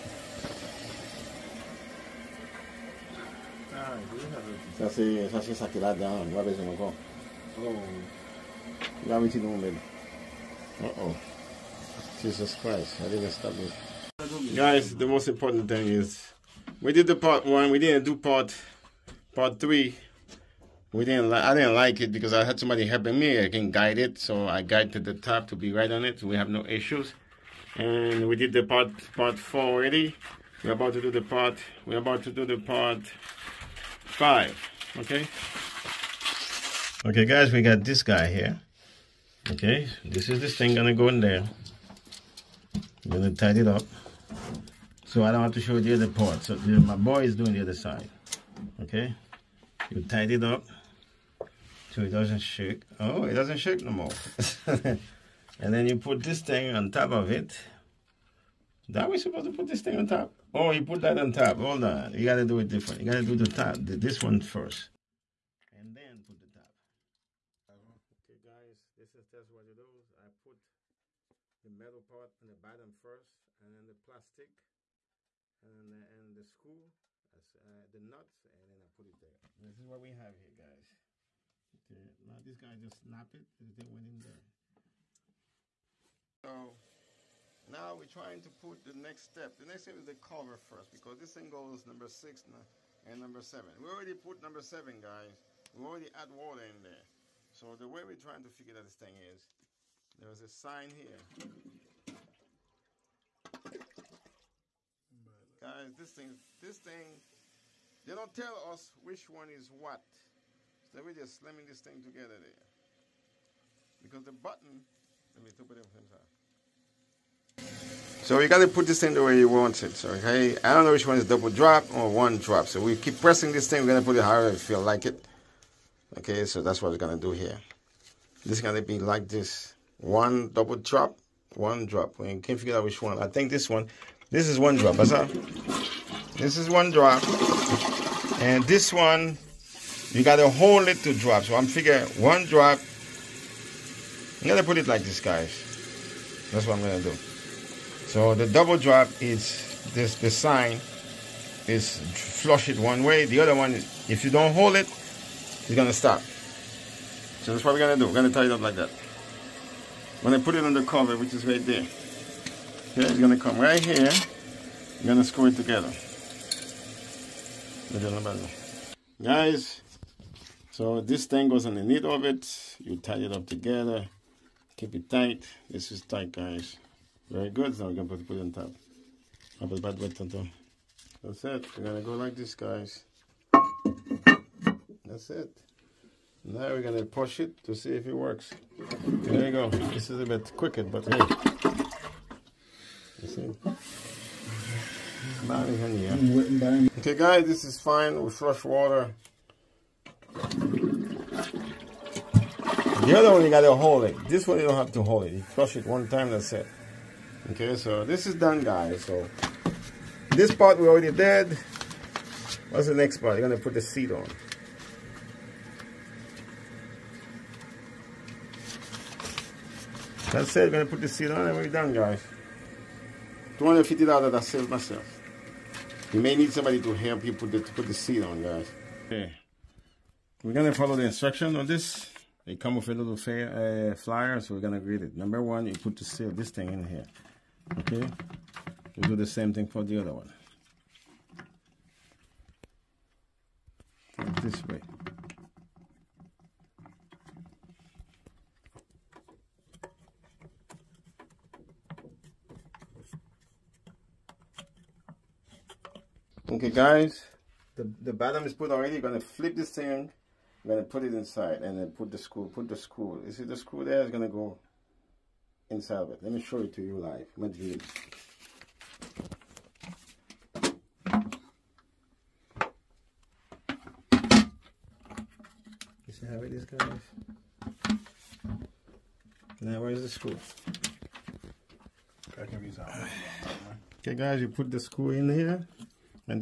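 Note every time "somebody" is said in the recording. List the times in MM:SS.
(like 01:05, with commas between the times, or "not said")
00:22, 03:46.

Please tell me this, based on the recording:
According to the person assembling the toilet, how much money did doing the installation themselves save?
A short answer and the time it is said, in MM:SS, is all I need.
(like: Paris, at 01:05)
$250, at 03:43.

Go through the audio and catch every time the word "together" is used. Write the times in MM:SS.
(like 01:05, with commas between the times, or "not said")
01:52, 02:45, 02:53.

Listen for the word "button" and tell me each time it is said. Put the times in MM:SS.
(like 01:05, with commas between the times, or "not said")
01:54.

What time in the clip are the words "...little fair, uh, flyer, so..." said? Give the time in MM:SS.
03:52.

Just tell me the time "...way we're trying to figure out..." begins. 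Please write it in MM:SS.
01:37.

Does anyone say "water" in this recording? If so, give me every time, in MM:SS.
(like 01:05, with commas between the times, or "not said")
01:36, 03:18.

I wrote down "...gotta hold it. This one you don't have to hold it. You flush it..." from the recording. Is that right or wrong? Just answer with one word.
wrong.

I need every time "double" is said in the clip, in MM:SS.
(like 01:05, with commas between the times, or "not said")
02:01, 02:10, 02:28.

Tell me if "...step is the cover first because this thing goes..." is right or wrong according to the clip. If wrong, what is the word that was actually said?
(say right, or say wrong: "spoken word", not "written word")
right.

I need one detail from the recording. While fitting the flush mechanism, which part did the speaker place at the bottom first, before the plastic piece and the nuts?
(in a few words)
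the metal part.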